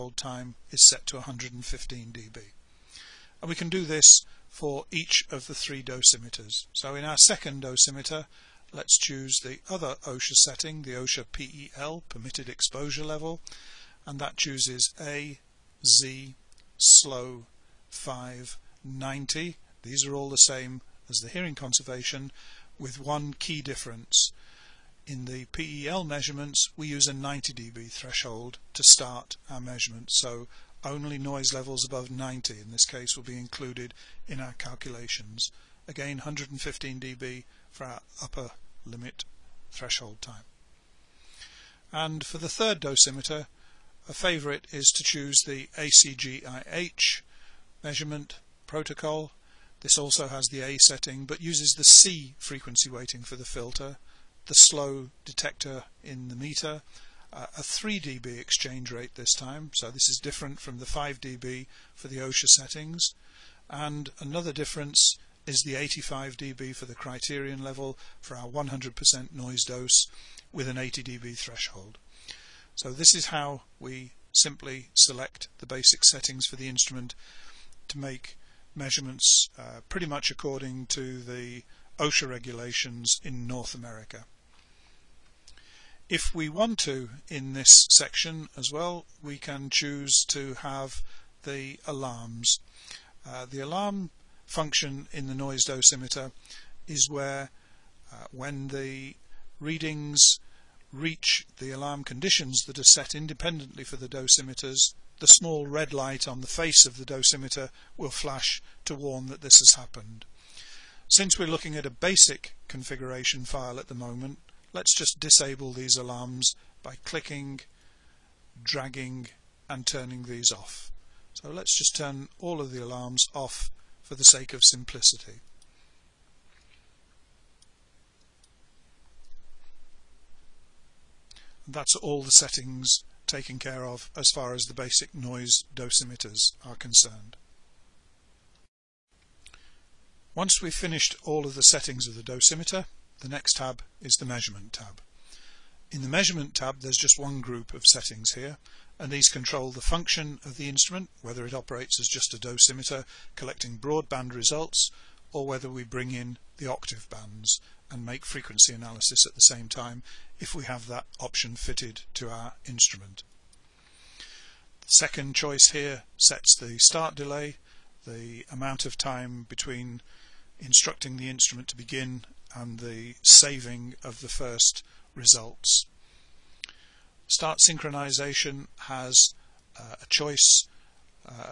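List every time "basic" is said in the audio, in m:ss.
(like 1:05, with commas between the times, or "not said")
1:15, 1:51, 2:14.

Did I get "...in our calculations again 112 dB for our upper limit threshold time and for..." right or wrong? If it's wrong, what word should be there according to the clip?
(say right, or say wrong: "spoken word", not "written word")
wrong: "115", not "112".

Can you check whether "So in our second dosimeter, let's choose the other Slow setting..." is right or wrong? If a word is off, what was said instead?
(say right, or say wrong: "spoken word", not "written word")
wrong: "OSHA", not "Slow".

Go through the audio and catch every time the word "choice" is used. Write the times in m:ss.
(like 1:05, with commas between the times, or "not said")
2:45, 3:00.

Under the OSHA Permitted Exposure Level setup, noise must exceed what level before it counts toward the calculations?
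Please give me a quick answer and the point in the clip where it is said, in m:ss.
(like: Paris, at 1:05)
90 dB, at 0:27.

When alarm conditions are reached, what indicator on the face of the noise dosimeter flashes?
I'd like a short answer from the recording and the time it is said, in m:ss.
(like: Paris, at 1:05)
small red light, at 1:45.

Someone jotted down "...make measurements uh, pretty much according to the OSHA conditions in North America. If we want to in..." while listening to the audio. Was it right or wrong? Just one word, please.
wrong.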